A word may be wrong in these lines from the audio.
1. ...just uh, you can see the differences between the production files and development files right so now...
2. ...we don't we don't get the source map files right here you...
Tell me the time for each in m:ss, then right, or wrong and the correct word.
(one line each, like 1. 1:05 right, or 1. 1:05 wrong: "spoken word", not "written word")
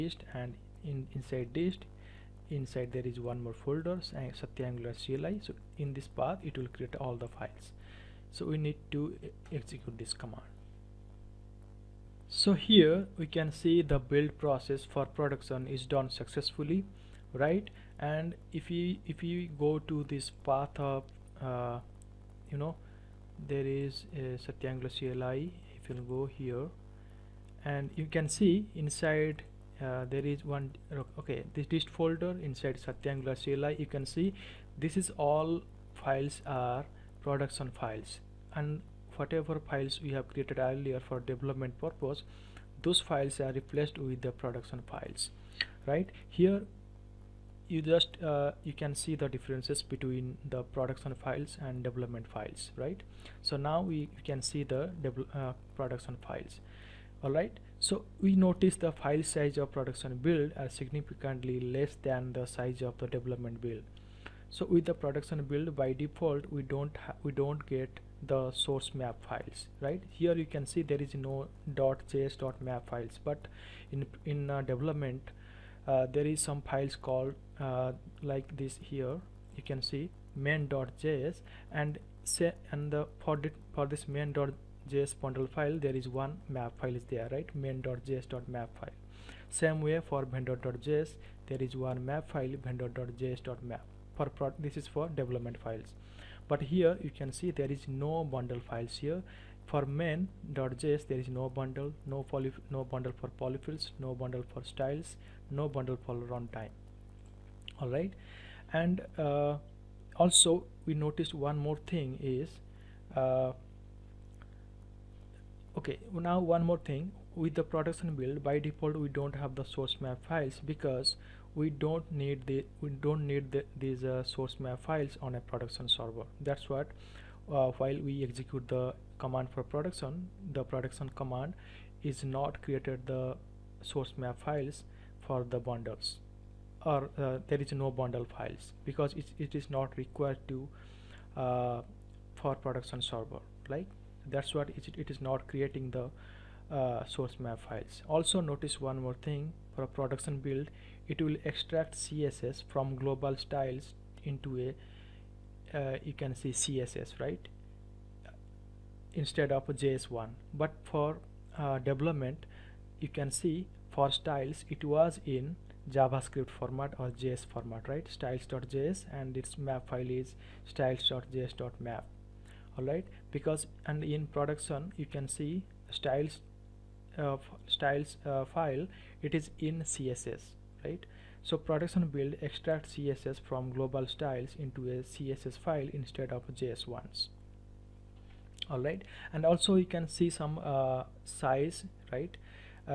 1. 0:47 right
2. 1:06 right.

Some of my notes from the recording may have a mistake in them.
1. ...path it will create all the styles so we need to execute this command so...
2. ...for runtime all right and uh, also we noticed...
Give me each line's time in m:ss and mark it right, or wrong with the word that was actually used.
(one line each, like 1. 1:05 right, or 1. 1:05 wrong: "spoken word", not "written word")
1. 0:06 wrong: "files", not "styles"
2. 1:46 right.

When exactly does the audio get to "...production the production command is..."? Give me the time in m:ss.
2:09.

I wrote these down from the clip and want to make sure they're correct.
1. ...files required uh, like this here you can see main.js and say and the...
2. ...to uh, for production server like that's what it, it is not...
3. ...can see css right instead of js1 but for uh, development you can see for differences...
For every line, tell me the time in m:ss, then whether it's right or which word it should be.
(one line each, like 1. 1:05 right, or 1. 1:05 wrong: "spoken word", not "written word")
1. 1:16 wrong: "called", not "required"
2. 2:20 right
3. 2:36 wrong: "styles", not "differences".